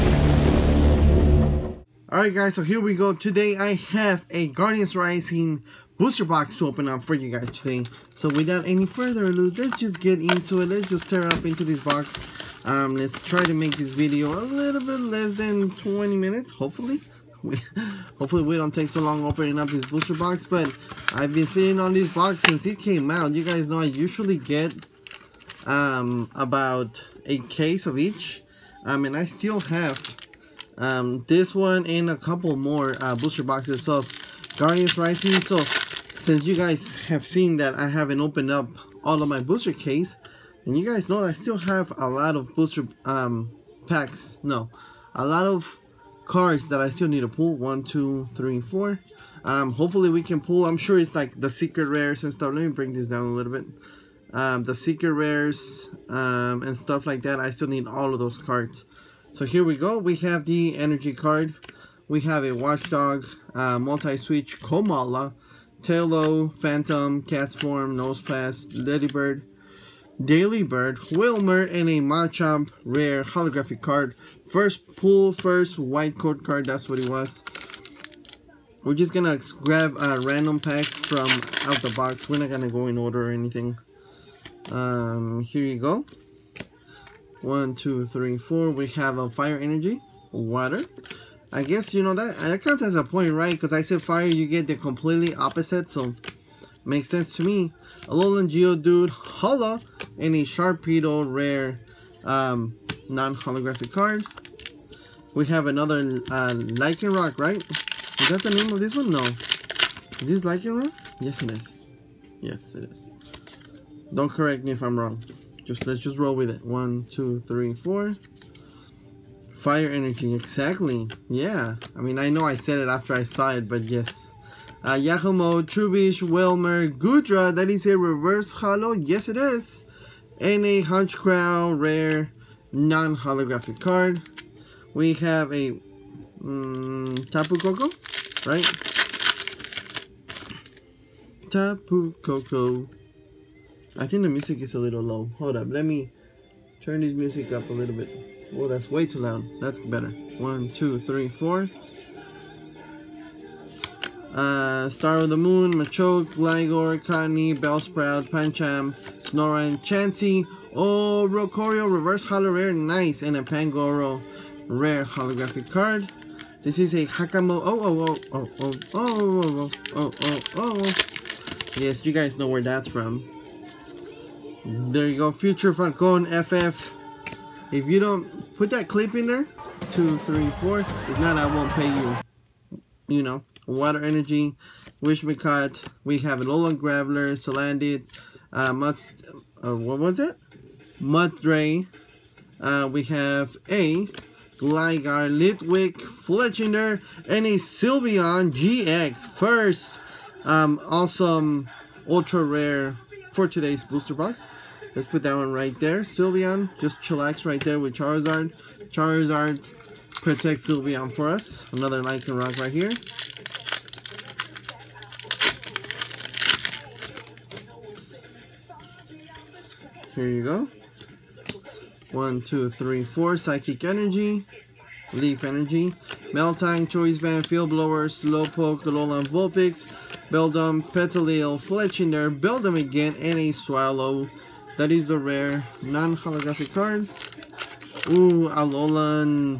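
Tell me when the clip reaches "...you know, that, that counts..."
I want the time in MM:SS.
01:31.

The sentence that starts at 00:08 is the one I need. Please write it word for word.
So without any further ado, let's just get into it.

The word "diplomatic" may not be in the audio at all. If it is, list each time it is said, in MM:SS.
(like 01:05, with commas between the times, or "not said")
not said.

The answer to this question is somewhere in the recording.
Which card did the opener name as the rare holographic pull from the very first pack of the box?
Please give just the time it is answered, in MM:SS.
01:11.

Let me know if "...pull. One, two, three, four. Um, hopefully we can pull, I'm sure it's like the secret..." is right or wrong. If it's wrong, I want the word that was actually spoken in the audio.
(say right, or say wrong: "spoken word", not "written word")
right.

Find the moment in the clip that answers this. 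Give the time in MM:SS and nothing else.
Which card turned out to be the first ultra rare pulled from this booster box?
03:17.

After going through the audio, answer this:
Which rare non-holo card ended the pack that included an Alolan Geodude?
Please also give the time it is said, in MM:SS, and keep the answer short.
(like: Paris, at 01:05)
Sharpedo, at 01:40.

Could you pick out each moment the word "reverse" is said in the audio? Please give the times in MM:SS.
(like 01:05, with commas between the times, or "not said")
02:07, 02:41.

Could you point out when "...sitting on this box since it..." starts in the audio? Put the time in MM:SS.
00:21.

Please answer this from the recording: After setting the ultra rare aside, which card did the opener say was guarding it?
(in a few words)
Charizard.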